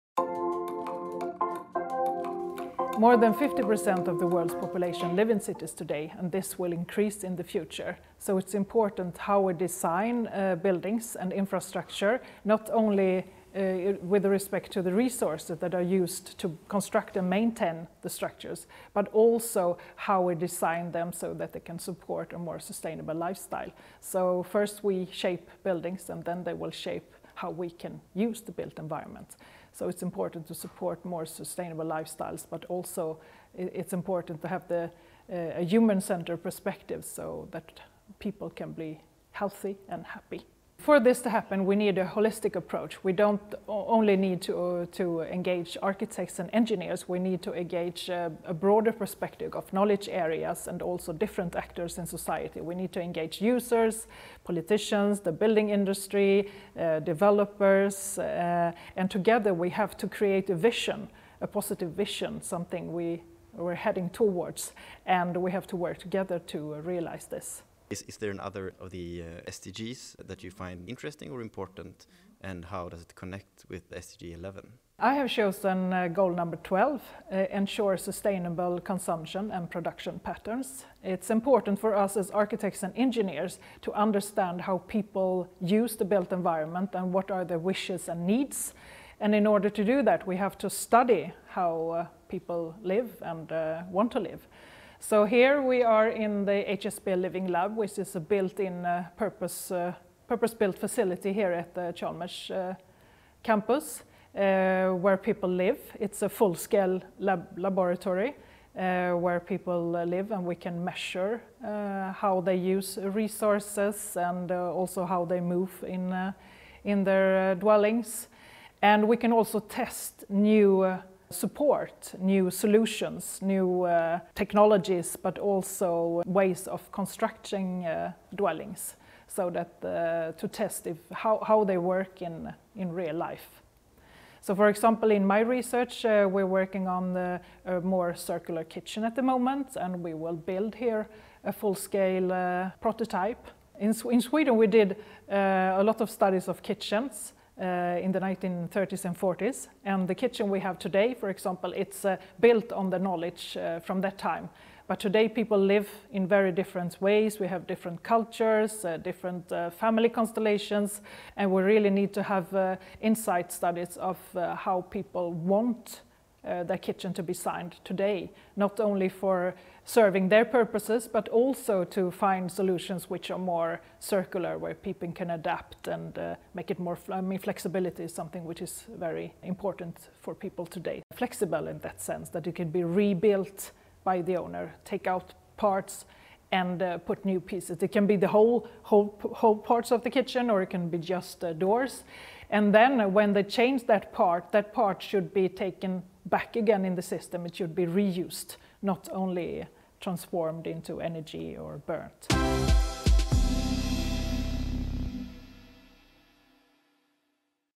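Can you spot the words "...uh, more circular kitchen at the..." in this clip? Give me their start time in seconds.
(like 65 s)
137 s.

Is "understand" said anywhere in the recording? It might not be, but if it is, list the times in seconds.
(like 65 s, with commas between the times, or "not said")
83 s.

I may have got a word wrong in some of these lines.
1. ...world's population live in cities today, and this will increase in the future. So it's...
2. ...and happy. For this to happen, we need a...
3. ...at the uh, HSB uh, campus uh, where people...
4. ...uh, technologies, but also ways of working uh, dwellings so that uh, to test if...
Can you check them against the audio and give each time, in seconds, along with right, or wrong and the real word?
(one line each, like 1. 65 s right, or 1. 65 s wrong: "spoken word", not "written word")
1. 4 s right
2. 39 s right
3. 101 s wrong: "Chalmers", not "HSB"
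4. 123 s wrong: "constructing", not "working".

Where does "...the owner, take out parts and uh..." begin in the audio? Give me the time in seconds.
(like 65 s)
184 s.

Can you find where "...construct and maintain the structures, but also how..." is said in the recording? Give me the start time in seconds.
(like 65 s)
16 s.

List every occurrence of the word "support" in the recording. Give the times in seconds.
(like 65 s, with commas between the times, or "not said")
21 s, 30 s, 121 s.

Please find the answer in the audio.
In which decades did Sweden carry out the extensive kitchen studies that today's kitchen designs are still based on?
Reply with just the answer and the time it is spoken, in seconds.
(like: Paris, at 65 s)
1930s and 40s, at 148 s.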